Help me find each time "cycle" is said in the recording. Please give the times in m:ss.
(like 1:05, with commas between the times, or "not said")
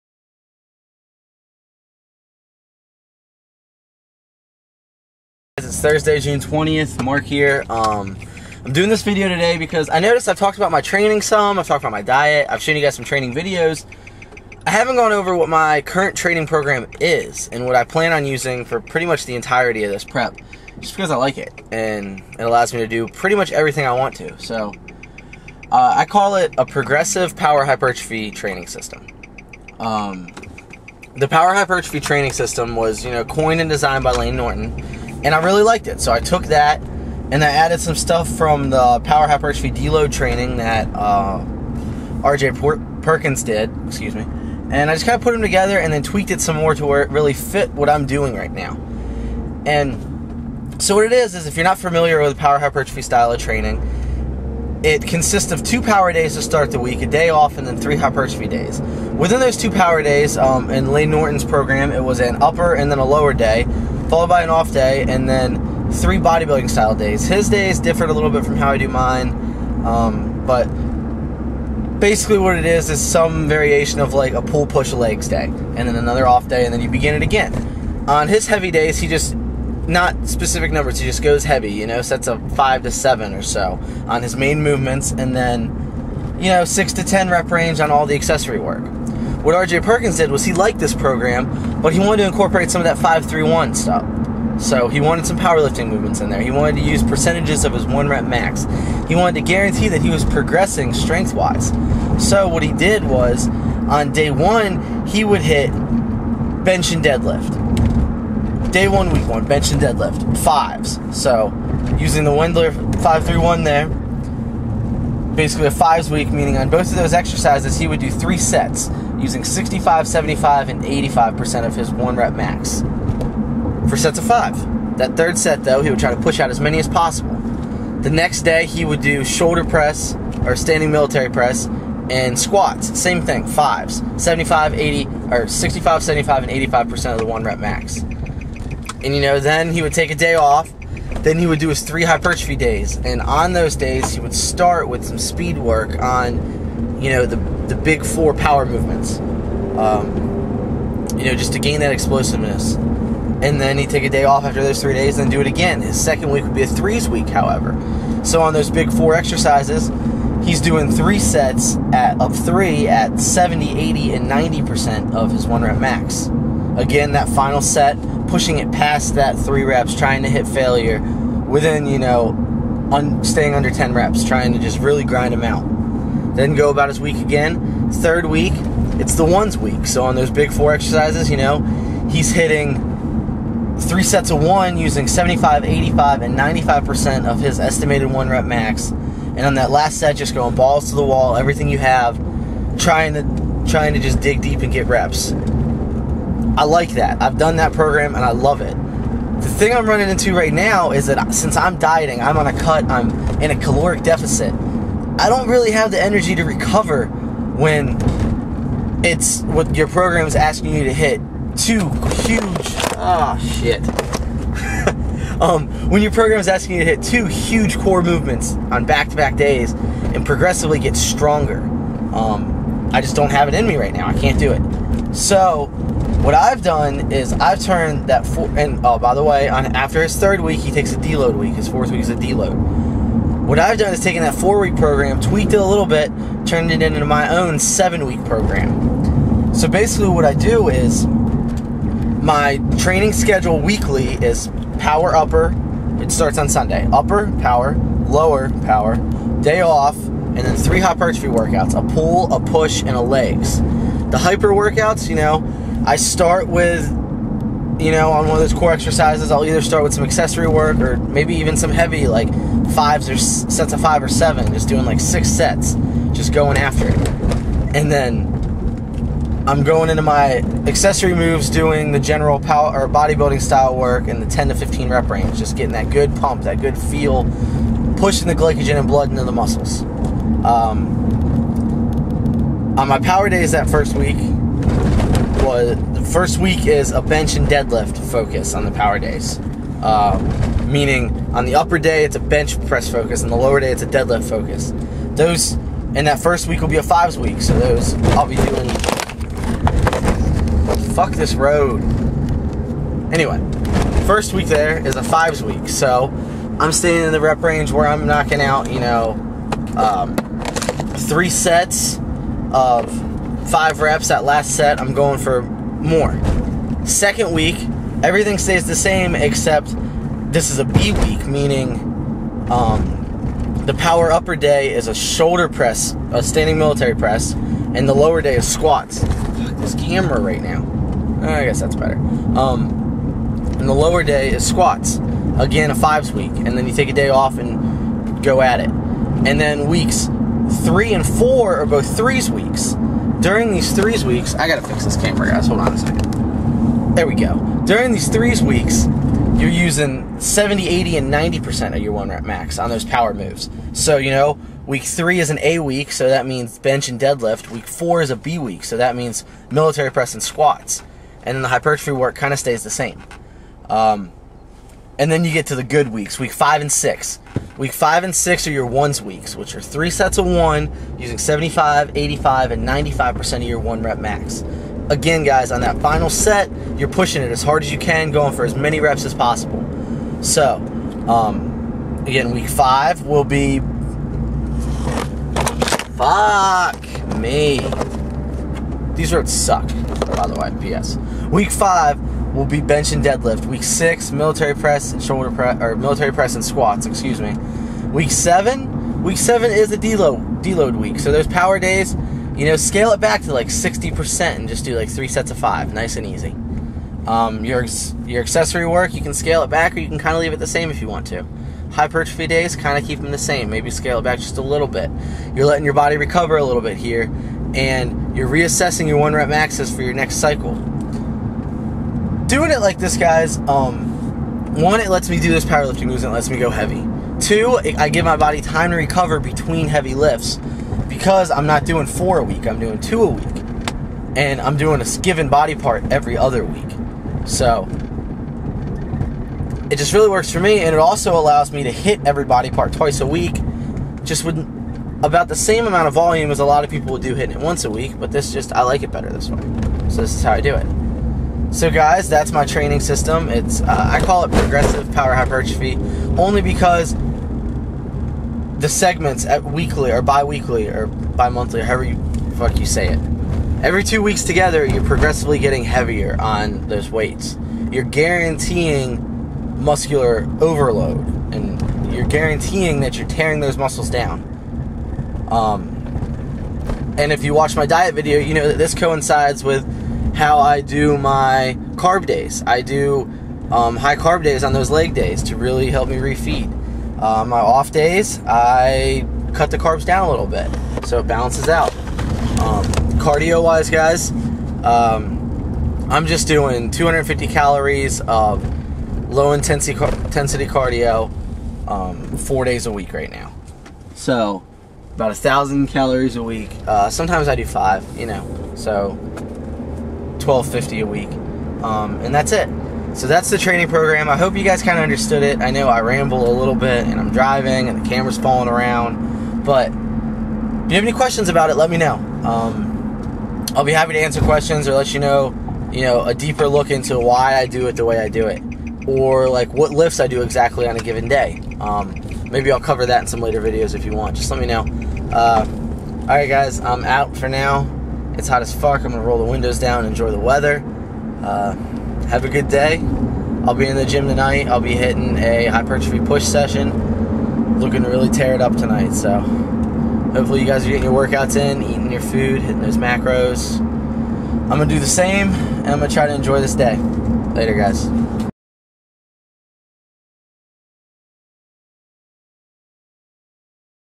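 7:00.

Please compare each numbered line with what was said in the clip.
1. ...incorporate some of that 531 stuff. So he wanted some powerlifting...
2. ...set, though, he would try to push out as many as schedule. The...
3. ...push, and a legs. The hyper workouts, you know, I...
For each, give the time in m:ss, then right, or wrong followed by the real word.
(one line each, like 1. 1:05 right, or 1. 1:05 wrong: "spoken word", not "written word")
1. 1:32 right
2. 2:05 wrong: "possible", not "schedule"
3. 4:12 right.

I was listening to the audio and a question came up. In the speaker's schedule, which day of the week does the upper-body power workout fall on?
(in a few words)
Sunday.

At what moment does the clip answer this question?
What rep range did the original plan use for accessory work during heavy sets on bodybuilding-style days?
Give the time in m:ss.
1:26.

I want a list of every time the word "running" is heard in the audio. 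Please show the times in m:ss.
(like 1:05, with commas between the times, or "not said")
3:19.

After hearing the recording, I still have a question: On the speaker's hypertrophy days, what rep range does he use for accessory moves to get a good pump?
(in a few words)
10 to 15.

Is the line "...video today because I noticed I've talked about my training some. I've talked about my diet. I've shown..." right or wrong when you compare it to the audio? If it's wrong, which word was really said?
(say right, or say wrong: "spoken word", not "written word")
right.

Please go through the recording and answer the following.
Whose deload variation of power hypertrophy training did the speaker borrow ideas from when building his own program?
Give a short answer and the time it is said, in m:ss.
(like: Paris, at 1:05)
RJ Perkins, at 0:42.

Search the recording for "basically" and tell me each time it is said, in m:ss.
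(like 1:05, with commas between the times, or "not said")
1:12, 1:55, 3:59.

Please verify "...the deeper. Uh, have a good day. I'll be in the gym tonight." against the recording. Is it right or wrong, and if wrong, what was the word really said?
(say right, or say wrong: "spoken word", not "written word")
wrong: "weather", not "deeper".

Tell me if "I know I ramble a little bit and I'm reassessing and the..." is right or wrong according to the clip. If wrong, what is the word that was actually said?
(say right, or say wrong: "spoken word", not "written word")
wrong: "driving", not "reassessing".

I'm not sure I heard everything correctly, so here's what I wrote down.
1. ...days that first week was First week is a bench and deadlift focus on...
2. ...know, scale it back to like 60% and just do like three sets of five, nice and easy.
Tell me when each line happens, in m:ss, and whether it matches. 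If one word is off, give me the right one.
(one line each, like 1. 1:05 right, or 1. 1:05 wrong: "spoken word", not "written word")
1. 4:43 right
2. 6:42 right.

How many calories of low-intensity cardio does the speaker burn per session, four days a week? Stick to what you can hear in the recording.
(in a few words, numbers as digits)
250.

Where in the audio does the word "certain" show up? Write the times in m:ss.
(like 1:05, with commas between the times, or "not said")
not said.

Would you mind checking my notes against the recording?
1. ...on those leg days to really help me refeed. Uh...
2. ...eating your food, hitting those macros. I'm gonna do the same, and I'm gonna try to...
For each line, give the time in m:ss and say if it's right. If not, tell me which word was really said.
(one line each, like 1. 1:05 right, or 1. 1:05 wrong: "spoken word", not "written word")
1. 8:04 right
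2. 9:11 right.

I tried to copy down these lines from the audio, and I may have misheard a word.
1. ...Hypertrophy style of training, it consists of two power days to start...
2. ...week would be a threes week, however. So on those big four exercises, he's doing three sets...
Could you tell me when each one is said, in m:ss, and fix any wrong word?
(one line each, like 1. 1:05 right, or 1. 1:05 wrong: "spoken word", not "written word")
1. 0:52 right
2. 2:36 right.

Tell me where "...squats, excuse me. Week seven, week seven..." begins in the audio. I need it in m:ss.
6:36.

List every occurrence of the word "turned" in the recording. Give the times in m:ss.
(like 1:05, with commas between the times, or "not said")
3:47, 3:56.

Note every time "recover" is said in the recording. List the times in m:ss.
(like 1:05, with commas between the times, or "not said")
3:26, 6:55, 7:08.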